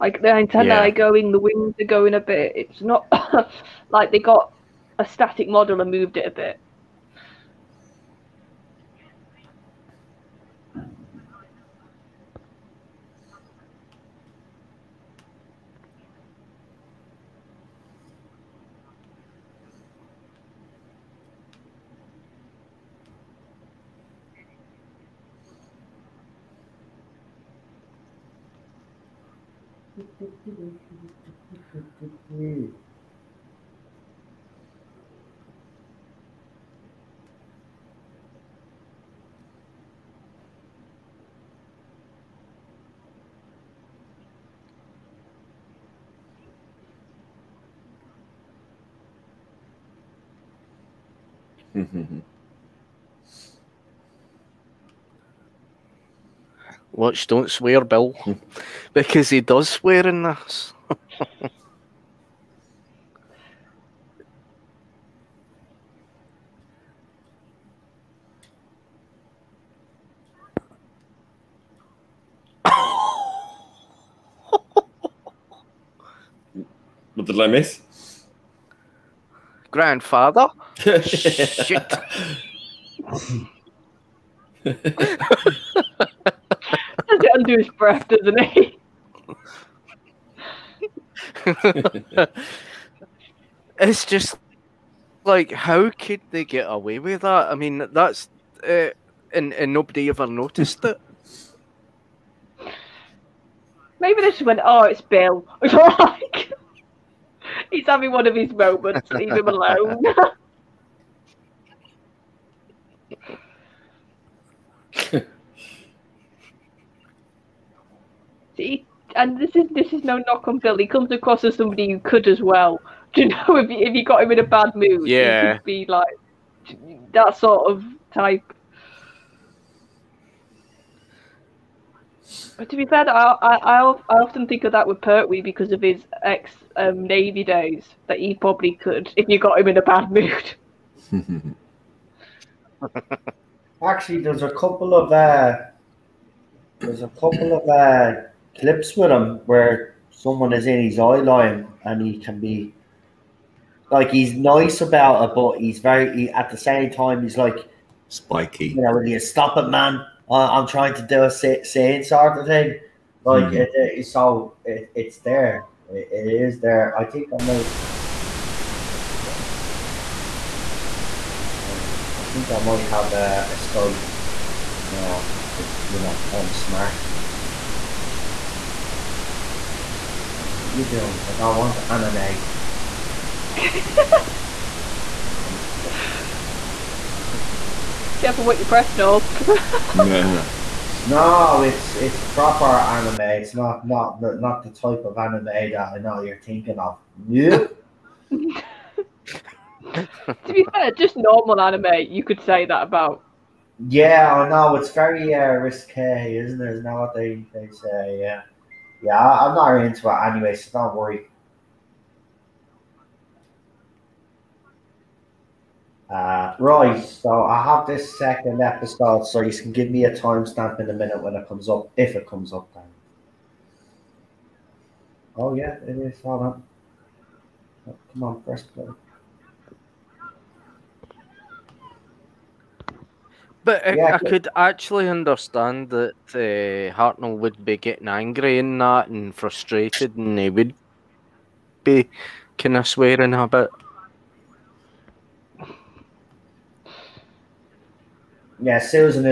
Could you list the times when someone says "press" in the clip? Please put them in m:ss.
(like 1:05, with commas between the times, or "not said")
3:08, 3:48.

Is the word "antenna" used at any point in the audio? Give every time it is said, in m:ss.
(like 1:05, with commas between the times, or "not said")
0:00.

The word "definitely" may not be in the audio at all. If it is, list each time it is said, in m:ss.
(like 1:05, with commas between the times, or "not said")
not said.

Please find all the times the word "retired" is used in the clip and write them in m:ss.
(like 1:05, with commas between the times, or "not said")
not said.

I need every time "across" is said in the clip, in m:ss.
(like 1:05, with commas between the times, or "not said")
2:01.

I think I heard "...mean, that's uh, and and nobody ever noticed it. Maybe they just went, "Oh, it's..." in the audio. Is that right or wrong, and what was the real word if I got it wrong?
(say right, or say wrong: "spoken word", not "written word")
right.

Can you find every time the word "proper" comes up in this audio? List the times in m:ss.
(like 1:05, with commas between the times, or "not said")
3:12.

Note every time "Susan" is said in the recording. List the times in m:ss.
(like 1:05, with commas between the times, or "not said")
4:08.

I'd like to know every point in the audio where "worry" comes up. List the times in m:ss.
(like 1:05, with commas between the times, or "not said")
3:30.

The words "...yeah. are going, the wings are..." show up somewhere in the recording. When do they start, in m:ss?
0:00.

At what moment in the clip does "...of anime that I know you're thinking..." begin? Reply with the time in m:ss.
3:15.